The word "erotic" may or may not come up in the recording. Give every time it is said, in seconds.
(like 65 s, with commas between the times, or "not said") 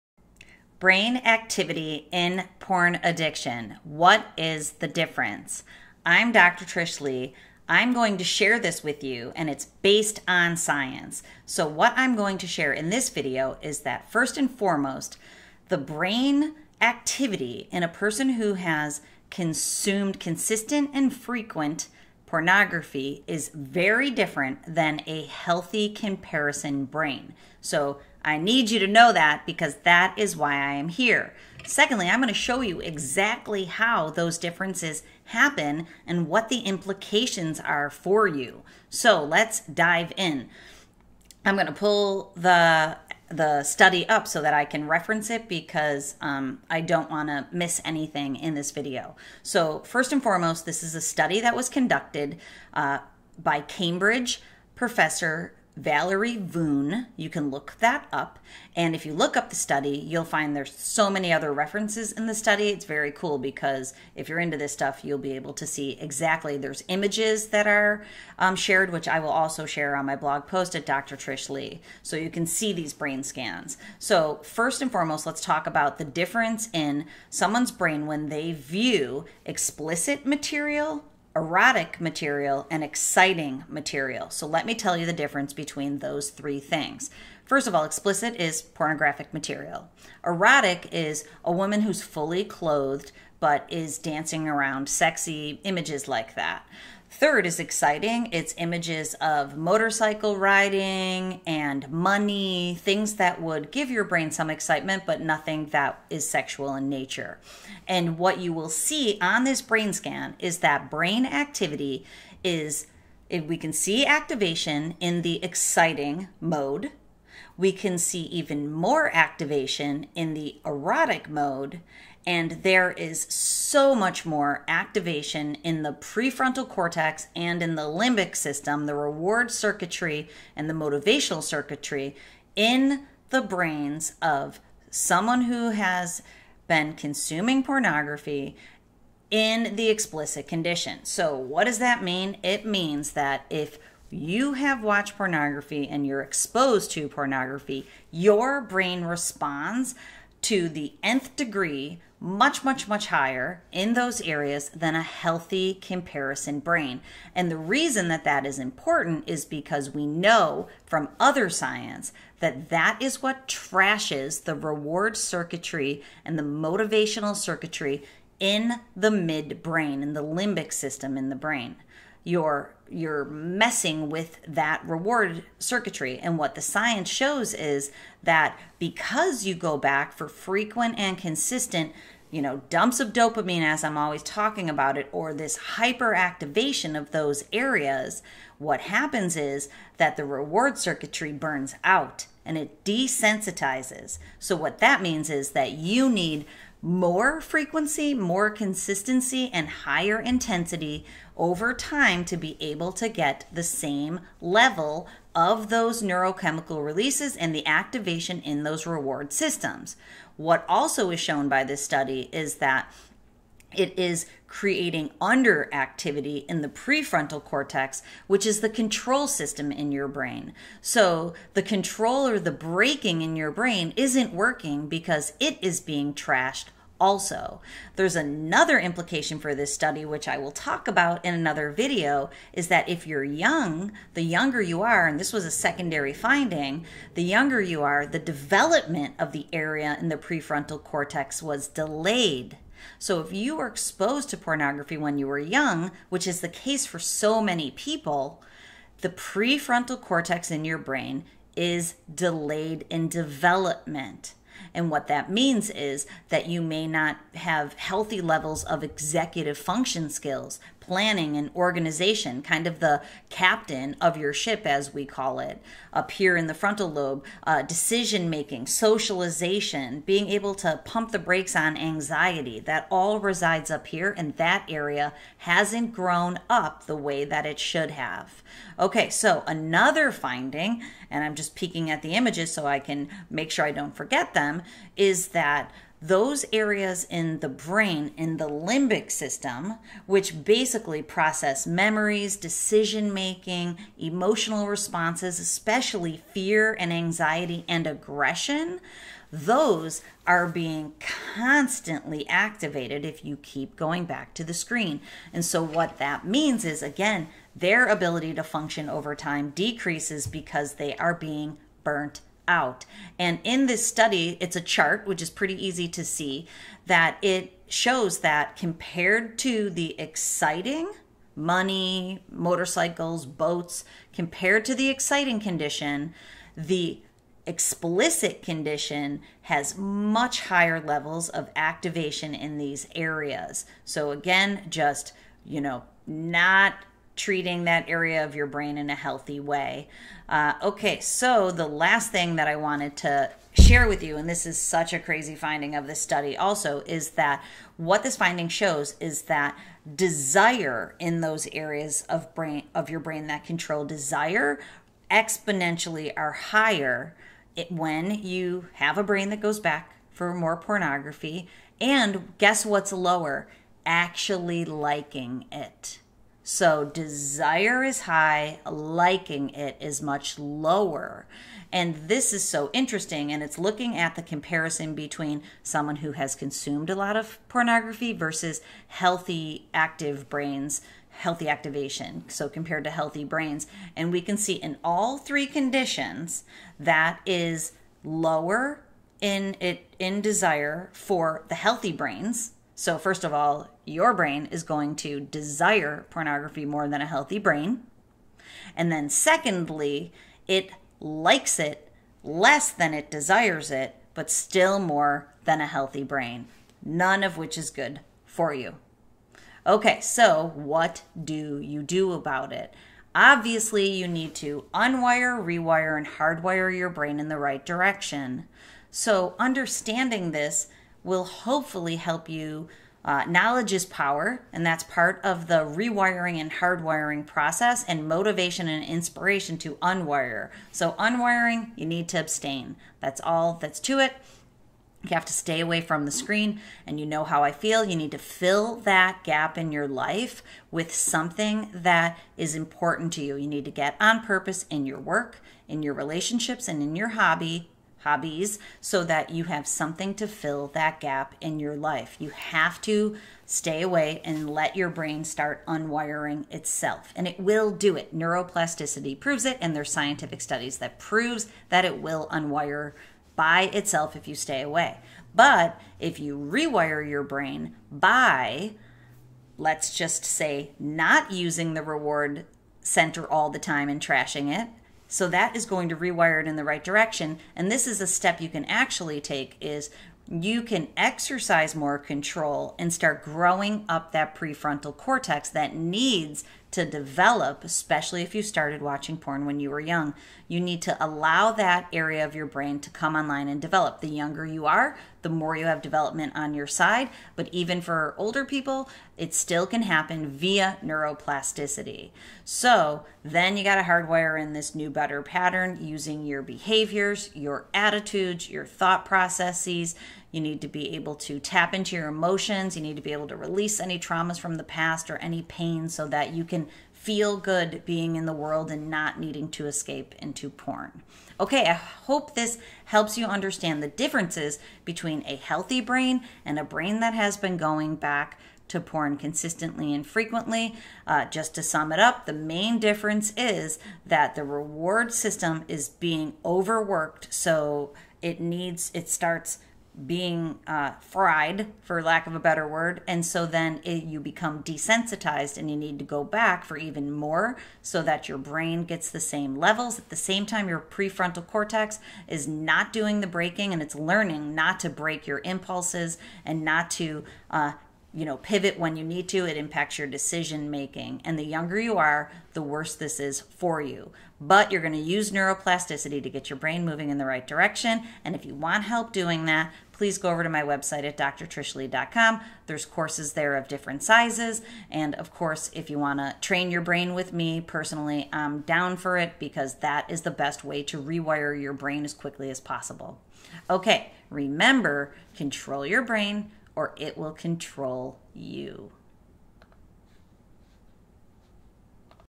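81 s, 90 s, 120 s.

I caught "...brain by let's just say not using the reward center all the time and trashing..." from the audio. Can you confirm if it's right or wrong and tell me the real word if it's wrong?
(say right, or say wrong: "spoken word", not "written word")
right.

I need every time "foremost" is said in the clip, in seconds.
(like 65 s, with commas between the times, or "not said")
14 s, 50 s, 74 s.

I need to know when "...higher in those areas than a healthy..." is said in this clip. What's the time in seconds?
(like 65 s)
153 s.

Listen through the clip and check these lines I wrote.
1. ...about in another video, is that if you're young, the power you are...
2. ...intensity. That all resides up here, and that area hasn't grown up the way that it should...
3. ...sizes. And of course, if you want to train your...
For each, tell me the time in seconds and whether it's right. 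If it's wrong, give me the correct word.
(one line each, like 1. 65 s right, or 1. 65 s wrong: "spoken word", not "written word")
1. 230 s wrong: "younger", not "power"
2. 271 s wrong: "anxiety", not "intensity"
3. 574 s right.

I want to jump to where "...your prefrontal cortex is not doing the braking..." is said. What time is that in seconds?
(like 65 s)
550 s.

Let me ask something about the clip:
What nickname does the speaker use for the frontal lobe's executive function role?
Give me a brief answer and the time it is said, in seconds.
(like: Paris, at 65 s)
Captain of your ship, at 263 s.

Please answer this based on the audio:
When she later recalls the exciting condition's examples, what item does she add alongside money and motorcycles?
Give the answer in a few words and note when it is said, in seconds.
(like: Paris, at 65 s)
Boats, at 323 s.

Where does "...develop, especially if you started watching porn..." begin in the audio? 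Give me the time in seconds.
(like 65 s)
486 s.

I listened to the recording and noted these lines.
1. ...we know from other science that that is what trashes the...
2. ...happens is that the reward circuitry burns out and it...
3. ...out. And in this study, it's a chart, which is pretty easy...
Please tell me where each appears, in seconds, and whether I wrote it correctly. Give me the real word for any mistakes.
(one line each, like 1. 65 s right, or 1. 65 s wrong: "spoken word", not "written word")
1. 159 s right
2. 188 s right
3. 312 s right.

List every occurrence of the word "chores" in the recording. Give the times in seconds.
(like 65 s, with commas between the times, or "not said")
not said.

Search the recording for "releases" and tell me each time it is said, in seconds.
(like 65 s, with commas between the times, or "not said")
206 s, 513 s.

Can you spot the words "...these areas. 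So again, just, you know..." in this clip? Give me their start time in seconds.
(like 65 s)
332 s.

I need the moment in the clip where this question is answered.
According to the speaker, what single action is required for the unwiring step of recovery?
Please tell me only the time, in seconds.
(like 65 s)
432 s.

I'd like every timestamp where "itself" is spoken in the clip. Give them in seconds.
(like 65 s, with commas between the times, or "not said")
456 s, 463 s.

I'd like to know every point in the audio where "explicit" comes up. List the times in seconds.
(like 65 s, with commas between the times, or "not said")
79 s, 87 s, 139 s, 327 s.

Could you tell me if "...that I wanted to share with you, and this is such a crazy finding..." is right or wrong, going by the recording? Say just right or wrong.
right.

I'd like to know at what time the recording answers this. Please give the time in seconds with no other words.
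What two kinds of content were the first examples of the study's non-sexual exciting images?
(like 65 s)
99 s.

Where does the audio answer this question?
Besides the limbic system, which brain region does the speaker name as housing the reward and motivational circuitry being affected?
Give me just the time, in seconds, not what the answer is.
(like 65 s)
169 s.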